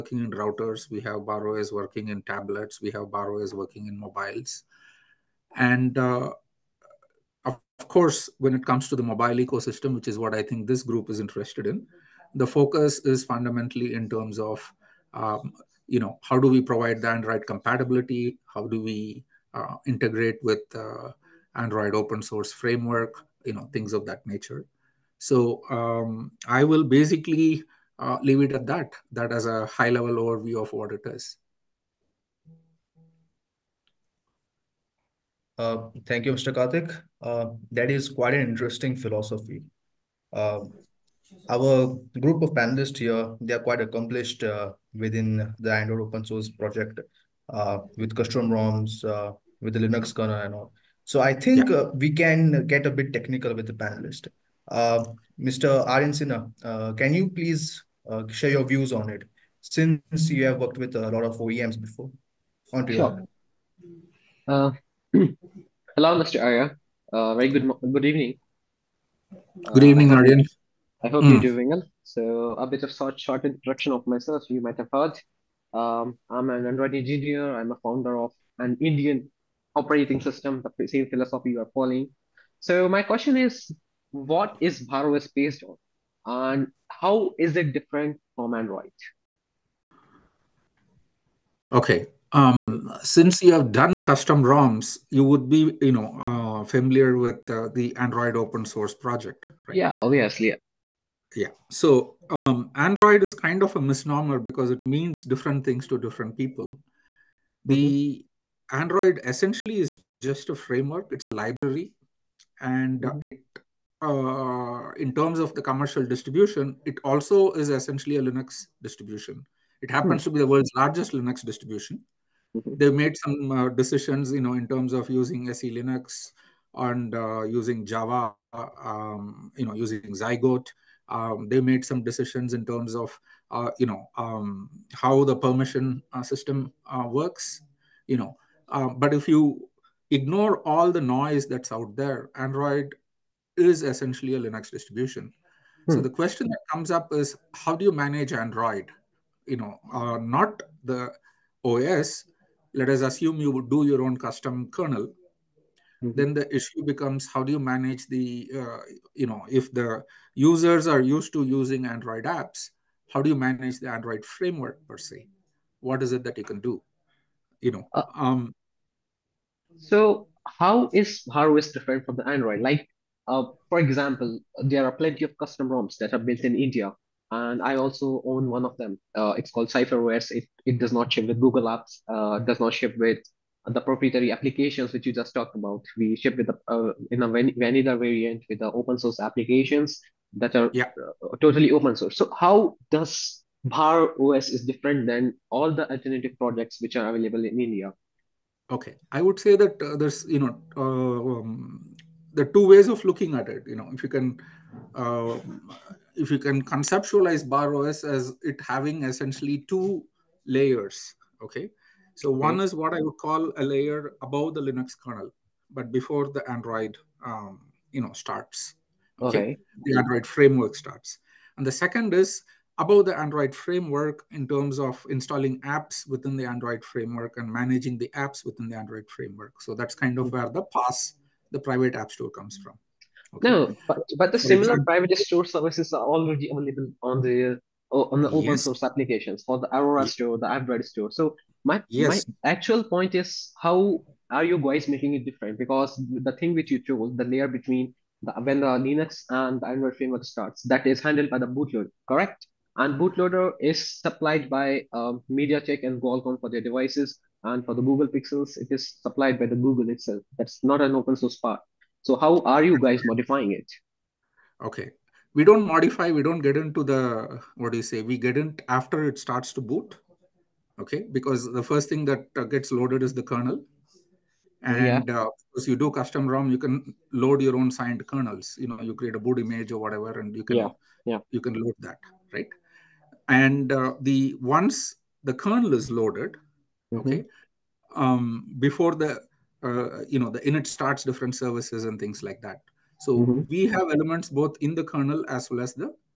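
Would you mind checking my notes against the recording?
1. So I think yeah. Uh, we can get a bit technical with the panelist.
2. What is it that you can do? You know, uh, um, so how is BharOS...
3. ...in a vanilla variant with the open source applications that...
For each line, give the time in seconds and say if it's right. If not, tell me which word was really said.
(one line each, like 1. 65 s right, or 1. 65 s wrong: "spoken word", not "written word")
1. 51 s right
2. 165 s right
3. 187 s right.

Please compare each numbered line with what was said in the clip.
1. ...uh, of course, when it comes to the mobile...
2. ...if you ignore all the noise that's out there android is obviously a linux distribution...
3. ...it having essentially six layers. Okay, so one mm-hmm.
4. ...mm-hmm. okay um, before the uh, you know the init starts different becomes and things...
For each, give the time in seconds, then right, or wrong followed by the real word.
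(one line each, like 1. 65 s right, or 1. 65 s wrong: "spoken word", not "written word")
1. 5 s right
2. 139 s wrong: "essentially", not "obviously"
3. 208 s wrong: "two", not "six"
4. 286 s wrong: "services", not "becomes".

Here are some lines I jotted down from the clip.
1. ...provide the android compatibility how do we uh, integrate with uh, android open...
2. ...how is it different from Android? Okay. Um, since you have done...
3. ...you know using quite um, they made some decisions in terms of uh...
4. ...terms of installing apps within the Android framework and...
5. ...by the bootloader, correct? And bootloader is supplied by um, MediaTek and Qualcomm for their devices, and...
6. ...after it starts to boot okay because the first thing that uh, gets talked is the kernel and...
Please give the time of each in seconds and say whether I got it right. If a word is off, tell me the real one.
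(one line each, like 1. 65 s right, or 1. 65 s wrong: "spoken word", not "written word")
1. 16 s right
2. 86 s right
3. 129 s wrong: "zygote", not "quite"
4. 224 s right
5. 251 s right
6. 268 s wrong: "loaded", not "talked".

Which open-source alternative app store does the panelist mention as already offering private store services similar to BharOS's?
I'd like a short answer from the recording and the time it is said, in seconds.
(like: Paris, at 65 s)
Aurora, at 239 s.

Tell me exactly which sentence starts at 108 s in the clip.
android essentially is just a framework it's a library and mm-hmm.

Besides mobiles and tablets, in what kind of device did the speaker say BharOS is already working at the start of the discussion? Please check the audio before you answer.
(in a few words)
Routers.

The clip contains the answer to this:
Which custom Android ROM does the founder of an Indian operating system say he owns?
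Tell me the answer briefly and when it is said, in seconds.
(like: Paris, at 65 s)
CypherOS, at 179 s.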